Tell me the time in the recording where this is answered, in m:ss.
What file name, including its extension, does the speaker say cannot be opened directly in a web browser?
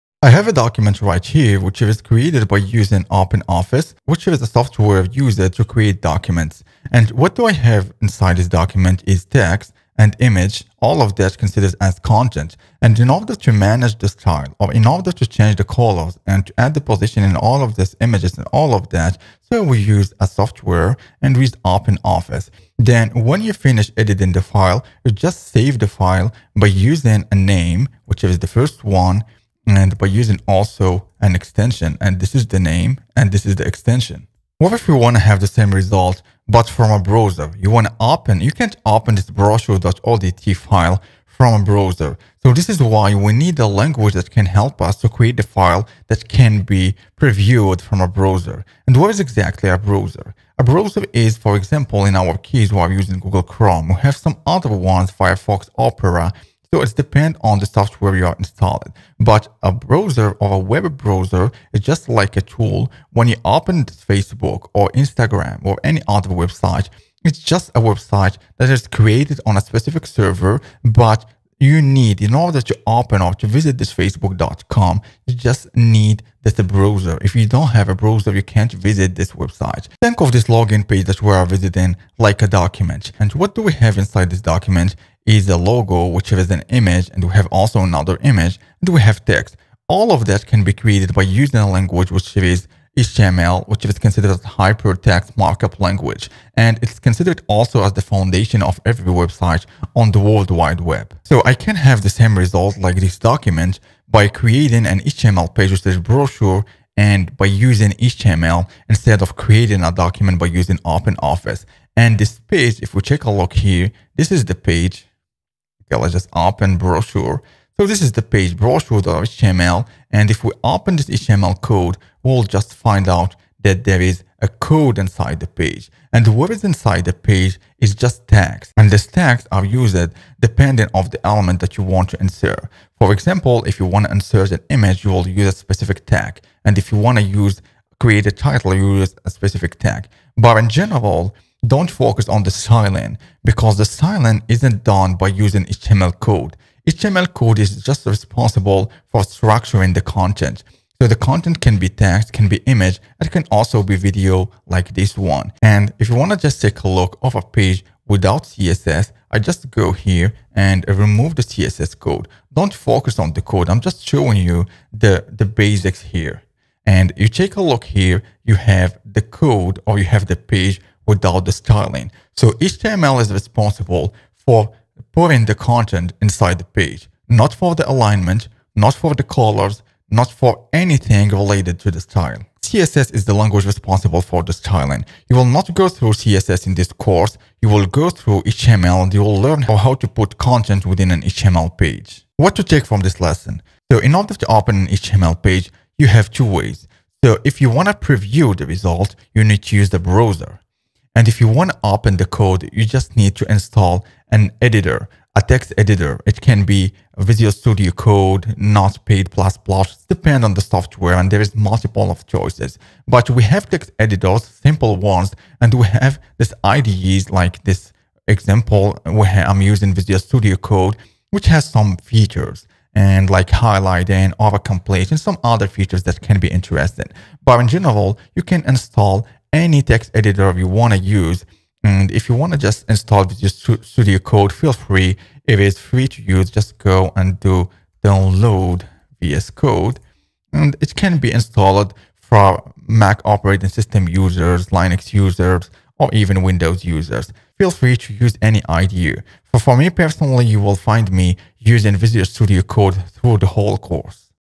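0:39.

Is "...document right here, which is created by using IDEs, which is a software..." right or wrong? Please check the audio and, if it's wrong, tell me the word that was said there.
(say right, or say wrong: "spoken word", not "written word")
wrong: "OpenOffice", not "IDEs".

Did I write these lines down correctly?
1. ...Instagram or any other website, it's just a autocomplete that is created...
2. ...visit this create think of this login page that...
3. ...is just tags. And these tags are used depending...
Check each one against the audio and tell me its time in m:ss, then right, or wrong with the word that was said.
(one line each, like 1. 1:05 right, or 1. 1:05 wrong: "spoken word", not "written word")
1. 1:04 wrong: "website", not "autocomplete"
2. 1:18 wrong: "website", not "create"
3. 2:07 right.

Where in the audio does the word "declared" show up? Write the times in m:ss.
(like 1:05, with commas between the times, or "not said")
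not said.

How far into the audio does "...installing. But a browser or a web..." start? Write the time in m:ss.
0:58.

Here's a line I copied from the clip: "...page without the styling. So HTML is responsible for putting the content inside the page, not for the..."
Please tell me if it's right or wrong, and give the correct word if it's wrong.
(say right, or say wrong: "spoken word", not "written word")
right.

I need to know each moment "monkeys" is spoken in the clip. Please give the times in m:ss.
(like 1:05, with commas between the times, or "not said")
not said.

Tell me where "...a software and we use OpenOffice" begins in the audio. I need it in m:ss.
0:20.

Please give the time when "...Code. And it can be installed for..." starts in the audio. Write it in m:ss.
3:59.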